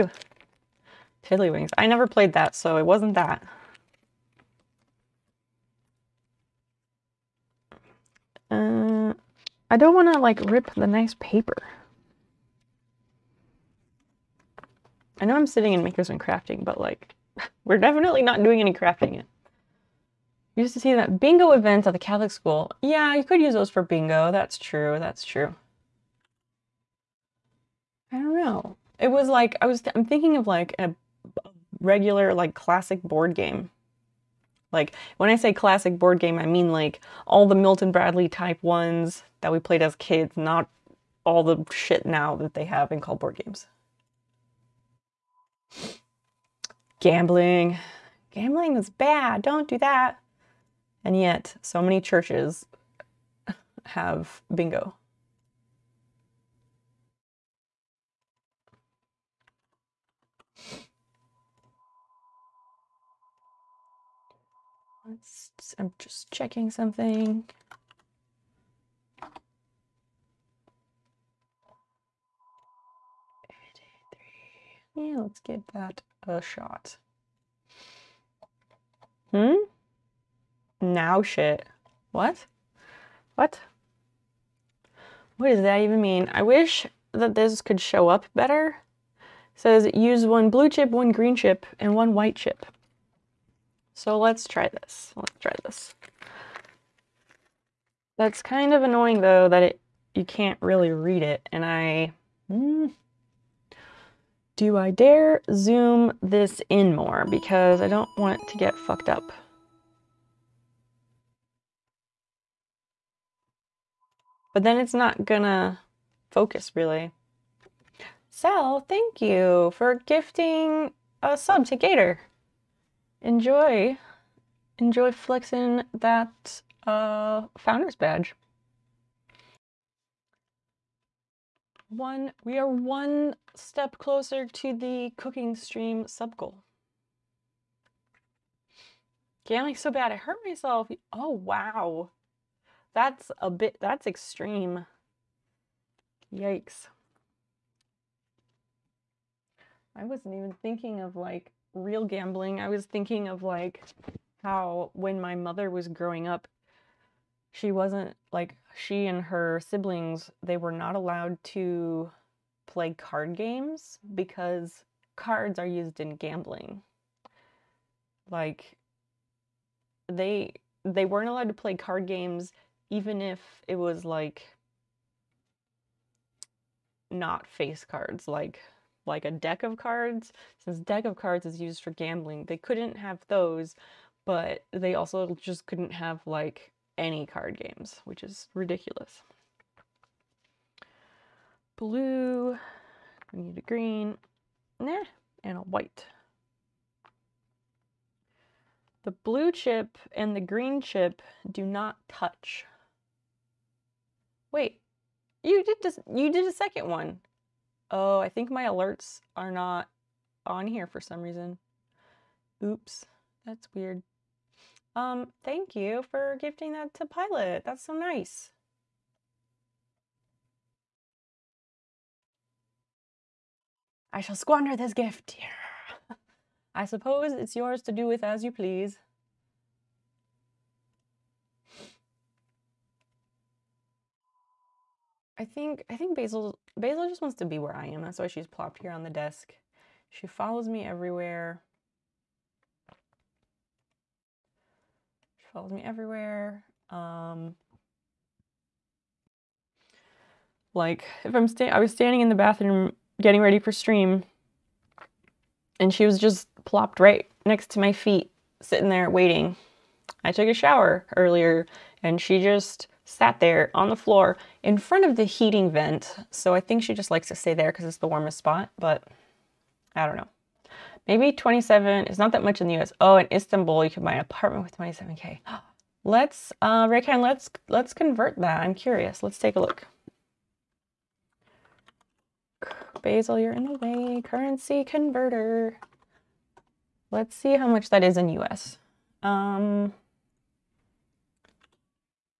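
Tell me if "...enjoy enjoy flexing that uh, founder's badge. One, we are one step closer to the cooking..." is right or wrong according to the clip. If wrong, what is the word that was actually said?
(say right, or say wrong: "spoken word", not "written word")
right.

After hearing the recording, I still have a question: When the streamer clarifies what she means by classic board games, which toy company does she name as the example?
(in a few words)
Milton Bradley.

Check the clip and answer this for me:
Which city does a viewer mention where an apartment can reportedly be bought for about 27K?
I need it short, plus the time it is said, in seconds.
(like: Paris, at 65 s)
Istanbul, at 273 s.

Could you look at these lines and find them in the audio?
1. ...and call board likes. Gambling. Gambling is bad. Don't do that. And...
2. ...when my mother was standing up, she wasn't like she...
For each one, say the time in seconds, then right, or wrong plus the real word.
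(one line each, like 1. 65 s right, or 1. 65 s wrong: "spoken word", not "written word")
1. 42 s wrong: "games", not "likes"
2. 154 s wrong: "growing", not "standing".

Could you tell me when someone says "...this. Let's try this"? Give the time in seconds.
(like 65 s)
94 s.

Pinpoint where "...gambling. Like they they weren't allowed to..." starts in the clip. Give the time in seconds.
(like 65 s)
166 s.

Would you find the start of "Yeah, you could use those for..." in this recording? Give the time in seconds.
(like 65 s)
22 s.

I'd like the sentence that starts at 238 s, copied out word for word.
That's why she's plopped here on the desk.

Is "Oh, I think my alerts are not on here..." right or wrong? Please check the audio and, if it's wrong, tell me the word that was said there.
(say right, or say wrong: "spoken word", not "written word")
right.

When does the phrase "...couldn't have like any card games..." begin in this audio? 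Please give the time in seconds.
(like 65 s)
185 s.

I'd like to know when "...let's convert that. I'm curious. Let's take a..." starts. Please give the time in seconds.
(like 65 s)
277 s.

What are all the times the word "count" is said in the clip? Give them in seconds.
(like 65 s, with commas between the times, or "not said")
not said.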